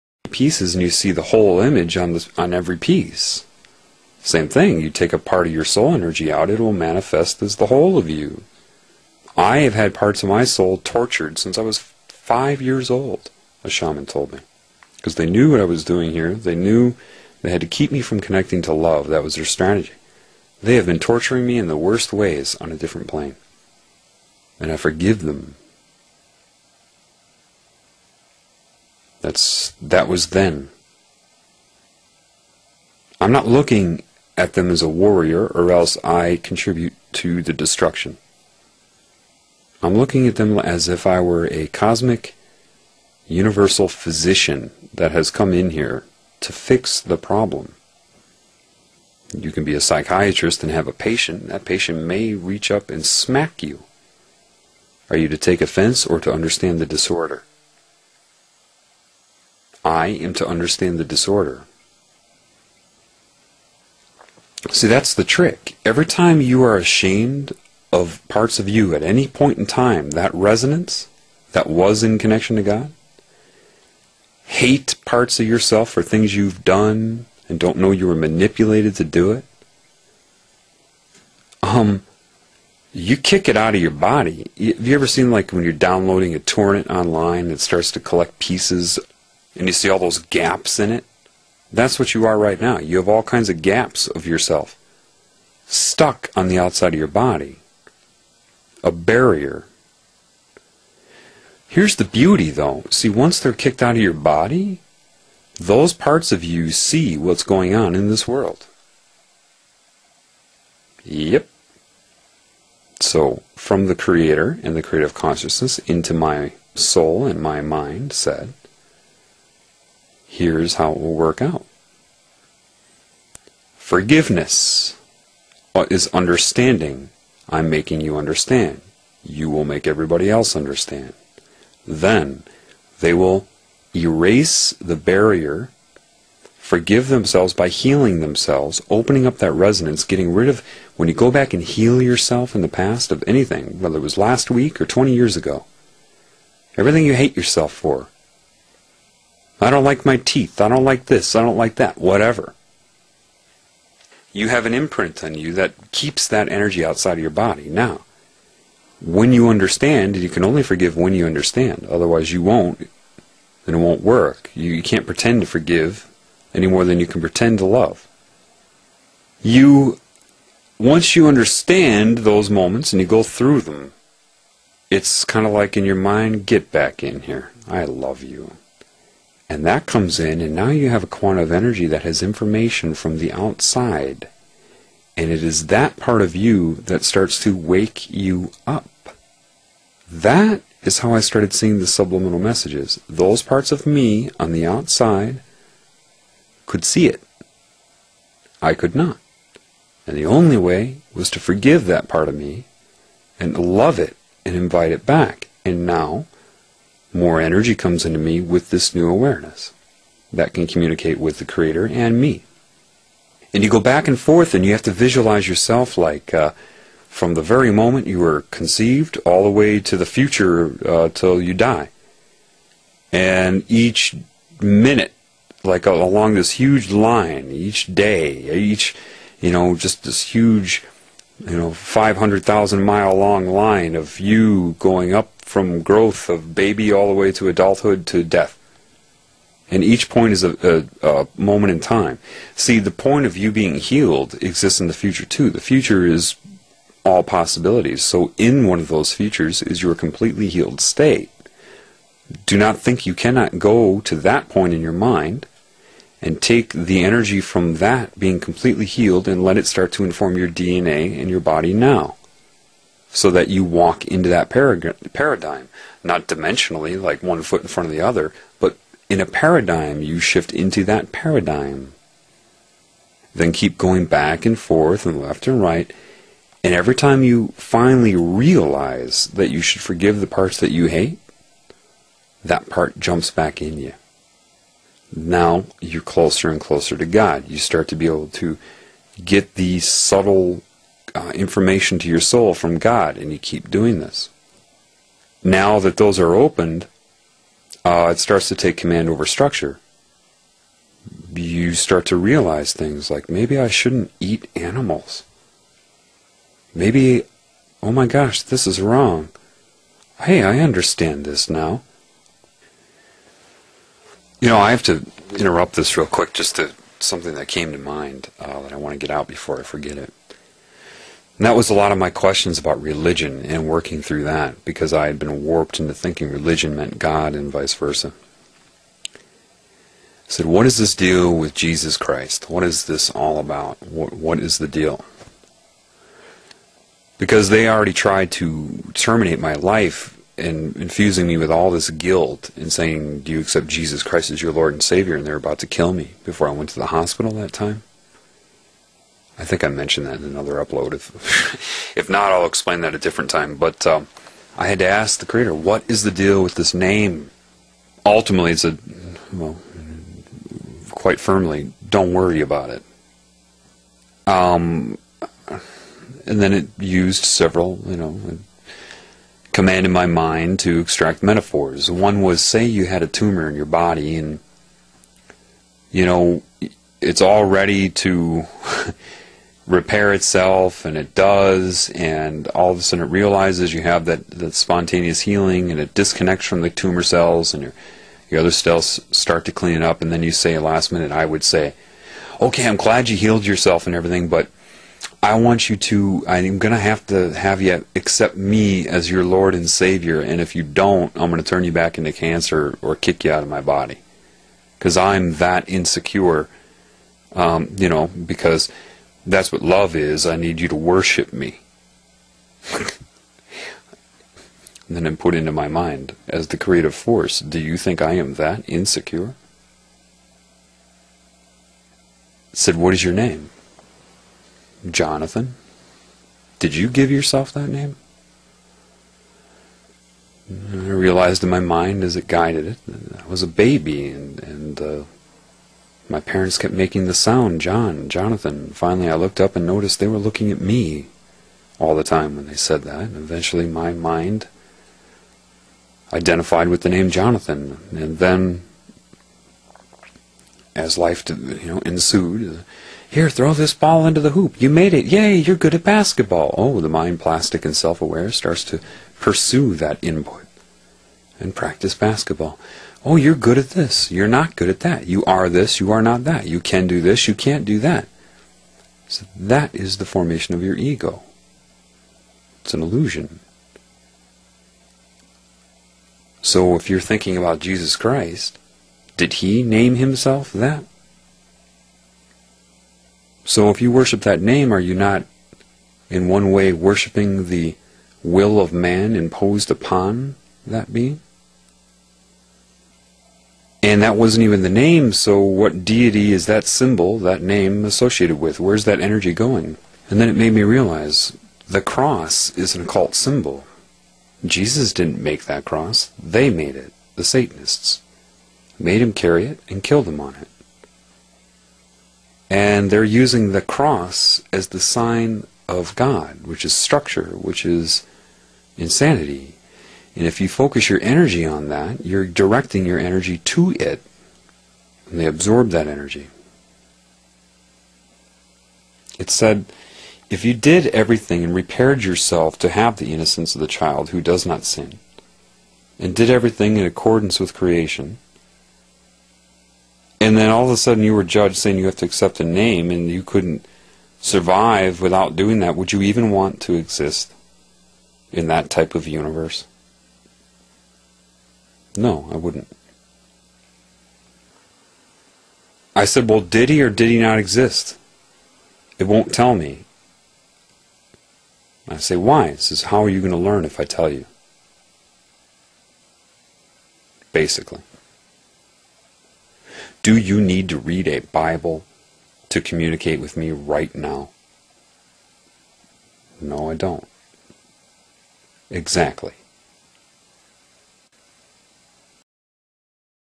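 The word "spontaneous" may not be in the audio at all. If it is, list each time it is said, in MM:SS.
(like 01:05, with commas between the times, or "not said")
06:24.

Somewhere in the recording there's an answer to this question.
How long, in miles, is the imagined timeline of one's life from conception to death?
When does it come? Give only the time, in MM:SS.
03:51.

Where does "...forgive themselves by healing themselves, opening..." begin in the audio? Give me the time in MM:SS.
02:16.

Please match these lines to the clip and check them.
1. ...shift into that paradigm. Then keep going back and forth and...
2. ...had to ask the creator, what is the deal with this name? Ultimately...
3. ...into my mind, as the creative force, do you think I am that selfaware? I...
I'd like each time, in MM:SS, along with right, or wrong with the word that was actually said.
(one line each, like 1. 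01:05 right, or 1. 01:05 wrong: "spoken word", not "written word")
1. 04:30 right
2. 05:54 right
3. 06:55 wrong: "insecure", not "selfaware".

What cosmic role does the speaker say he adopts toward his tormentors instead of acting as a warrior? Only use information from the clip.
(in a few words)
cosmic universal physician.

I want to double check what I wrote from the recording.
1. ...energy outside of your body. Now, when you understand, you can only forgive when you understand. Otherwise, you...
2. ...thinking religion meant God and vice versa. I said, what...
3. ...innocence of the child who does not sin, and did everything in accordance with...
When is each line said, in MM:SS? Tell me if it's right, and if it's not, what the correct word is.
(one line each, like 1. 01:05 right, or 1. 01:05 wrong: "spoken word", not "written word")
1. 02:36 right
2. 05:25 right
3. 08:53 right.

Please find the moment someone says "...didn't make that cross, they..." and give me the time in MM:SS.
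08:24.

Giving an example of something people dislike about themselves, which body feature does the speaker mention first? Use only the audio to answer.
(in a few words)
teeth.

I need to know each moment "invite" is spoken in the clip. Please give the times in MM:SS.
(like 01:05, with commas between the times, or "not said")
03:24.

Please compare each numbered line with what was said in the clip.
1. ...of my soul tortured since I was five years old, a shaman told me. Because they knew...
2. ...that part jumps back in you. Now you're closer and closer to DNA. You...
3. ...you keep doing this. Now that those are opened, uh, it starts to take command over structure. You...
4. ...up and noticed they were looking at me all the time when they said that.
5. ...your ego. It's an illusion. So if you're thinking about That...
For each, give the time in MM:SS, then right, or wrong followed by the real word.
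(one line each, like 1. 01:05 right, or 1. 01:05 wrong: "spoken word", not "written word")
1. 00:10 right
2. 04:42 wrong: "God", not "DNA"
3. 04:53 right
4. 07:19 right
5. 07:50 wrong: "Jesus", not "That".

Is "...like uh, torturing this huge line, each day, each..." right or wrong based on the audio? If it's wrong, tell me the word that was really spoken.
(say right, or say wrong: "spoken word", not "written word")
wrong: "along", not "torturing".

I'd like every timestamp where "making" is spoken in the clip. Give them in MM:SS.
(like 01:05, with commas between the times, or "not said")
02:07, 07:16.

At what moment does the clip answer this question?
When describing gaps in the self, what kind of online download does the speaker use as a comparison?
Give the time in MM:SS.
01:26.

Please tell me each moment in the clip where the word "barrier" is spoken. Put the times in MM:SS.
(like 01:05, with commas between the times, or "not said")
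01:38, 02:14.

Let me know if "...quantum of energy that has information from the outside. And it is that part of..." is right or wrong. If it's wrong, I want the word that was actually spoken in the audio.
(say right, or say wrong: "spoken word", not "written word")
right.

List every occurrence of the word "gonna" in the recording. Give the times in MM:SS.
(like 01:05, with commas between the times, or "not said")
06:36, 06:41.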